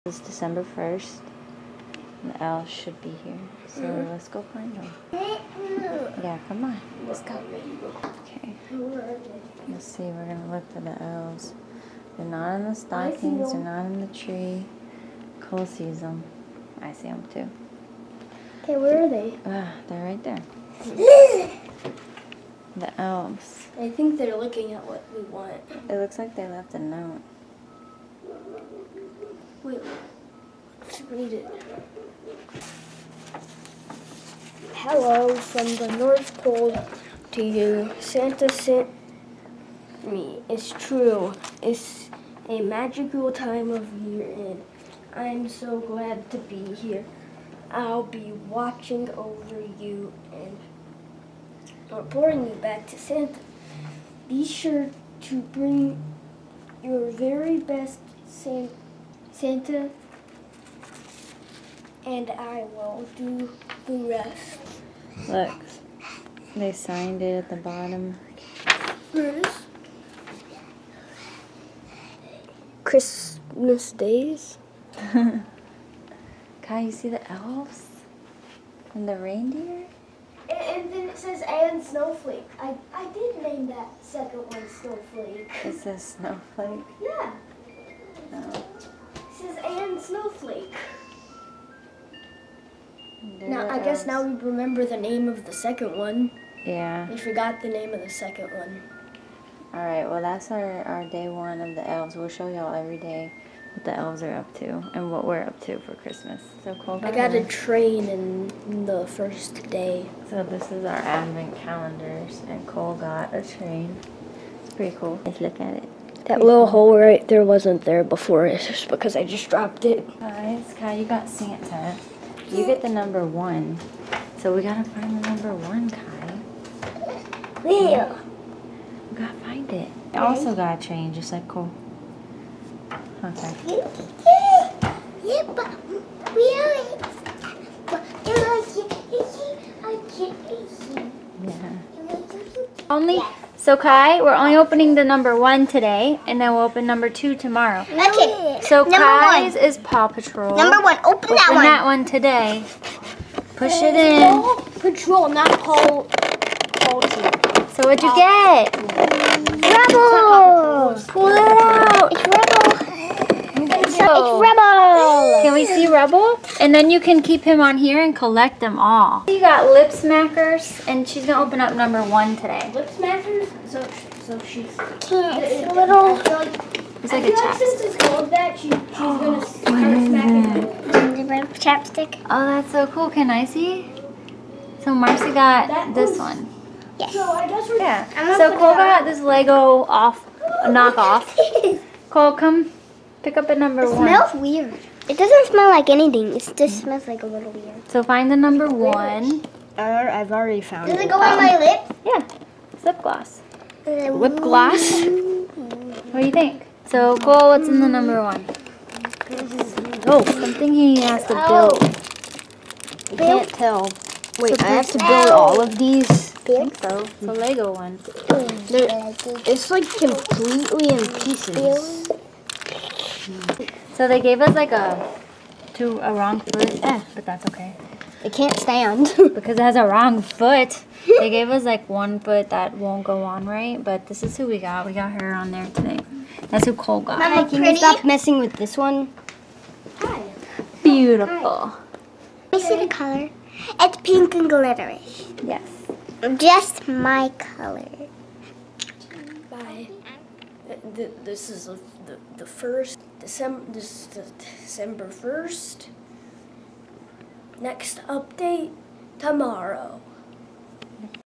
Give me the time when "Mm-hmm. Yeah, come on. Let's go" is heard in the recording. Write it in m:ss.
0:05.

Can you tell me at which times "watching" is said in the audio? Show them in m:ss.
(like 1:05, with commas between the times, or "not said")
0:48.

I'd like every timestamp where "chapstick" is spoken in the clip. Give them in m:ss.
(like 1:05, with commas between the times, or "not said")
2:57, 3:01.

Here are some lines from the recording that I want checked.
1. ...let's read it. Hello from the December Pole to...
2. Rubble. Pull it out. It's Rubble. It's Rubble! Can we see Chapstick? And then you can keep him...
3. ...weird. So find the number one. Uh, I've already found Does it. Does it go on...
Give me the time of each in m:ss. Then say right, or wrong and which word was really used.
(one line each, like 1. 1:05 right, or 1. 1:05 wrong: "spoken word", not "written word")
1. 0:30 wrong: "North", not "December"
2. 2:39 wrong: "Rubble", not "Chapstick"
3. 3:17 right.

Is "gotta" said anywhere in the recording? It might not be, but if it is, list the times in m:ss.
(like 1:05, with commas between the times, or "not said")
2:04, 2:09.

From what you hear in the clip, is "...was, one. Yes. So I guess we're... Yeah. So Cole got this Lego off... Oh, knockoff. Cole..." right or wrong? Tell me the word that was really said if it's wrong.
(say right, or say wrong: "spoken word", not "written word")
right.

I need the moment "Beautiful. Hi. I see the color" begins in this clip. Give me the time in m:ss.
4:00.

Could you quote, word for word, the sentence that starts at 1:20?
And, then it says, and snowflake.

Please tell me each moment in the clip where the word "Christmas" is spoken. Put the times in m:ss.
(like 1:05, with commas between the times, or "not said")
1:12, 1:45.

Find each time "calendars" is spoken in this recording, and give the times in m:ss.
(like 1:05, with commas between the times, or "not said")
1:51.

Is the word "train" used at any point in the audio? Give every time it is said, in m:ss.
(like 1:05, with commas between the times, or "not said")
1:47, 1:53, 2:10.